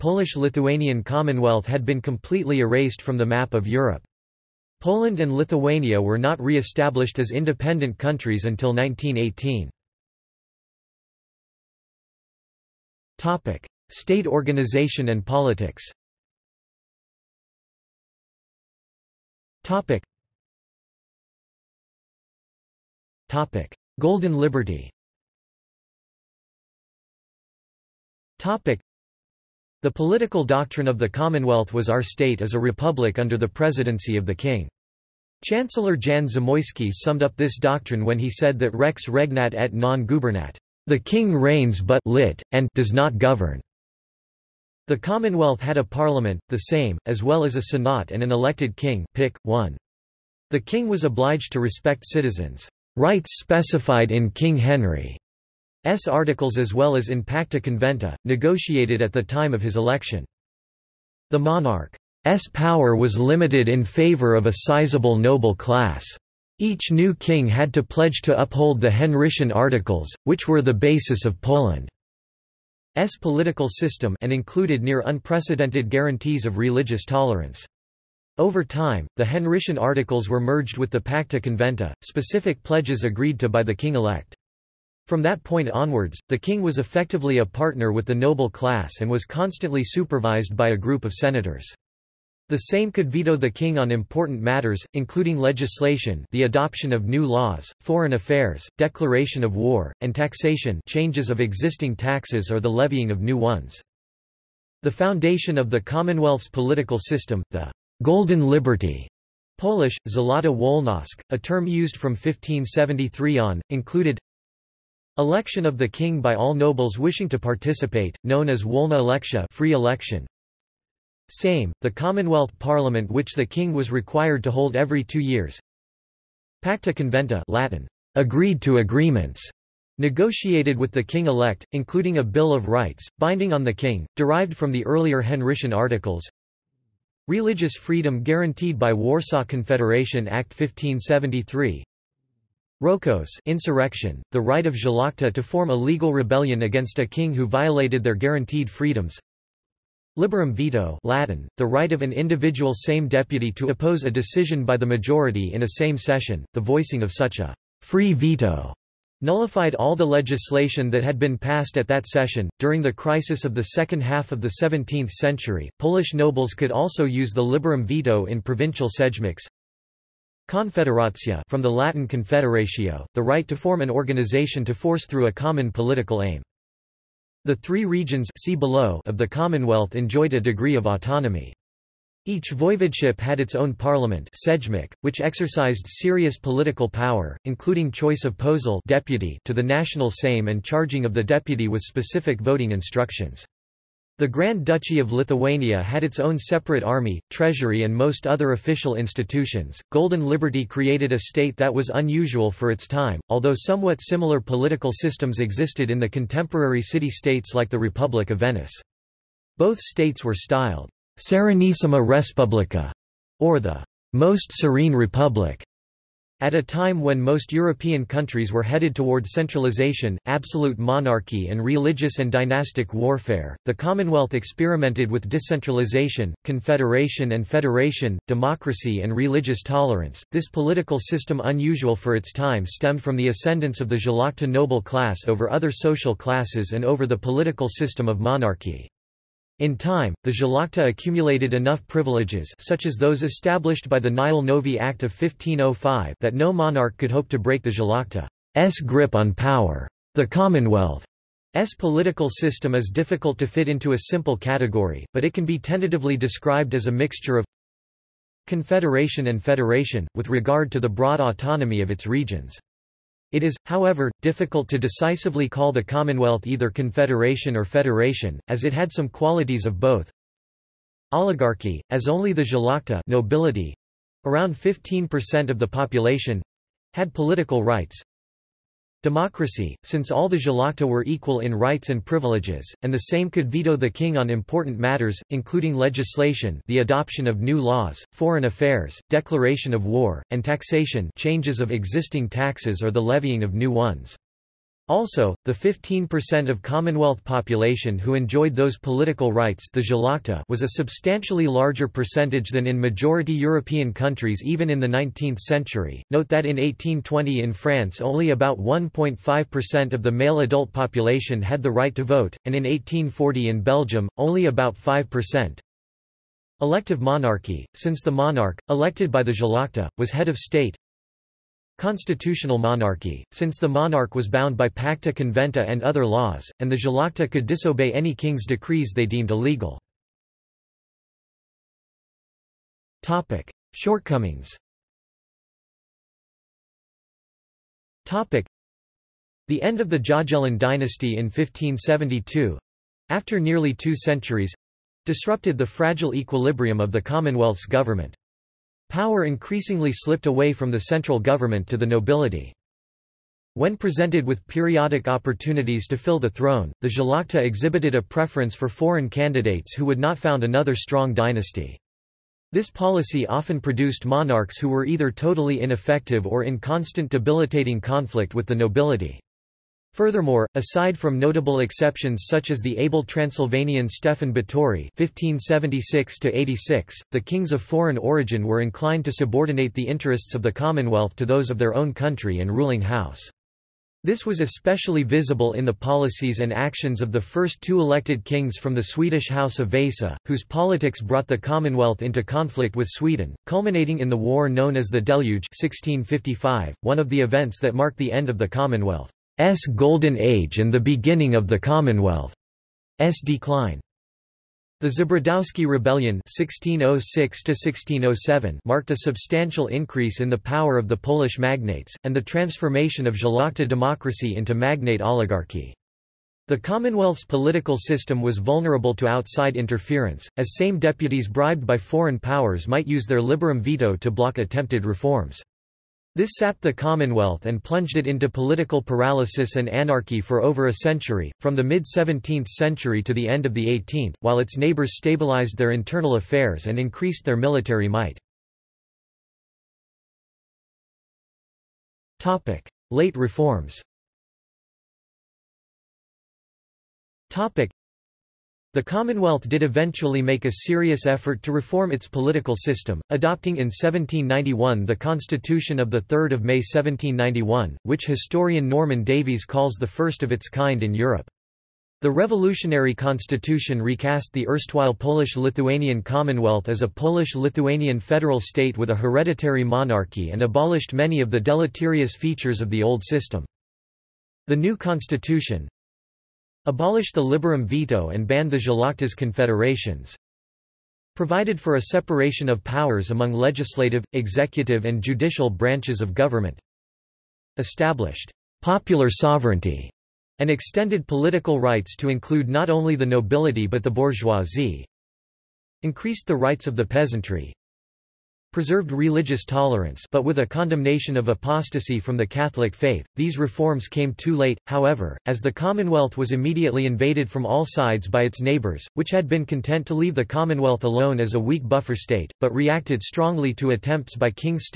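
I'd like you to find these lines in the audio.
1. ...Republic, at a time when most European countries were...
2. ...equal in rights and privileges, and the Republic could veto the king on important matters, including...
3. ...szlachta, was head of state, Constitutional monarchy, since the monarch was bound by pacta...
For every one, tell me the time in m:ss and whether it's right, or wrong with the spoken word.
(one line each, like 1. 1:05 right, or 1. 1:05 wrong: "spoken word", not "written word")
1. 3:34 right
2. 4:41 wrong: "Sejm", not "Republic"
3. 5:19 right.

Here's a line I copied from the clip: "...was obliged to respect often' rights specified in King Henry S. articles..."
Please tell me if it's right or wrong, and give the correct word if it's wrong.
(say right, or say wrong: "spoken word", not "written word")
wrong: "citizens", not "often".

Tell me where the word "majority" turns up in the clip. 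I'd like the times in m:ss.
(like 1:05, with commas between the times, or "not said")
2:34, 5:02.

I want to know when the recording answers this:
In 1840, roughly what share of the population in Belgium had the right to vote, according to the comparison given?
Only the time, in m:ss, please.
5:14.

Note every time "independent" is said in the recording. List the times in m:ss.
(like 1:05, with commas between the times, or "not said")
0:07.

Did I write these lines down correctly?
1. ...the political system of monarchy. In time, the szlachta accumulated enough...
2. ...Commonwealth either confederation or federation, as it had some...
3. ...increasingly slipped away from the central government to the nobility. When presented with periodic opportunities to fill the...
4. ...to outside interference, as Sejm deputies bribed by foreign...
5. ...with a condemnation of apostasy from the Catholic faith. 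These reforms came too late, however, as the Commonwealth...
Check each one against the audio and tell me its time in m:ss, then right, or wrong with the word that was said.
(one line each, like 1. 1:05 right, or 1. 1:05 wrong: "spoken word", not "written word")
1. 3:57 right
2. 4:25 right
3. 5:49 right
4. 6:58 right
5. 8:20 right.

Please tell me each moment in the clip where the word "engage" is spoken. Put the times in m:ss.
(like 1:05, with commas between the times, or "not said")
not said.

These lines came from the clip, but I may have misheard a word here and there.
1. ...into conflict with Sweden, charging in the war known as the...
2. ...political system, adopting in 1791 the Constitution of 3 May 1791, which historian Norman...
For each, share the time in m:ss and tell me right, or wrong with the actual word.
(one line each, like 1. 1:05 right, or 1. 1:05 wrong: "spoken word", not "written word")
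1. 6:32 wrong: "culminating", not "charging"
2. 7:32 right.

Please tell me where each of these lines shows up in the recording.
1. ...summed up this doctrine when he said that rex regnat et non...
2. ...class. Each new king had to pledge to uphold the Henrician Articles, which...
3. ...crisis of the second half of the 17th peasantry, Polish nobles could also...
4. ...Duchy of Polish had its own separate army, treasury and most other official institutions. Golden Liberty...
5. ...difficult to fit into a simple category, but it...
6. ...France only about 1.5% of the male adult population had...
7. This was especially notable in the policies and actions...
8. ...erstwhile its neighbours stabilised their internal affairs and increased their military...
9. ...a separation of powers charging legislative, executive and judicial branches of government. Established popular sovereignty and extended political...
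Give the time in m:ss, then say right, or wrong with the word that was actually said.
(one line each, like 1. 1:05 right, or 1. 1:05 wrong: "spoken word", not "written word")
1. 0:36 right
2. 1:05 right
3. 2:42 wrong: "century", not "peasantry"
4. 3:14 wrong: "Lithuania", not "Polish"
5. 4:12 right
6. 5:07 right
7. 6:24 wrong: "visible", not "notable"
8. 7:14 wrong: "while", not "erstwhile"
9. 8:01 wrong: "among", not "charging".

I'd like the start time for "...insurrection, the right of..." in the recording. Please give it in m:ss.
2:23.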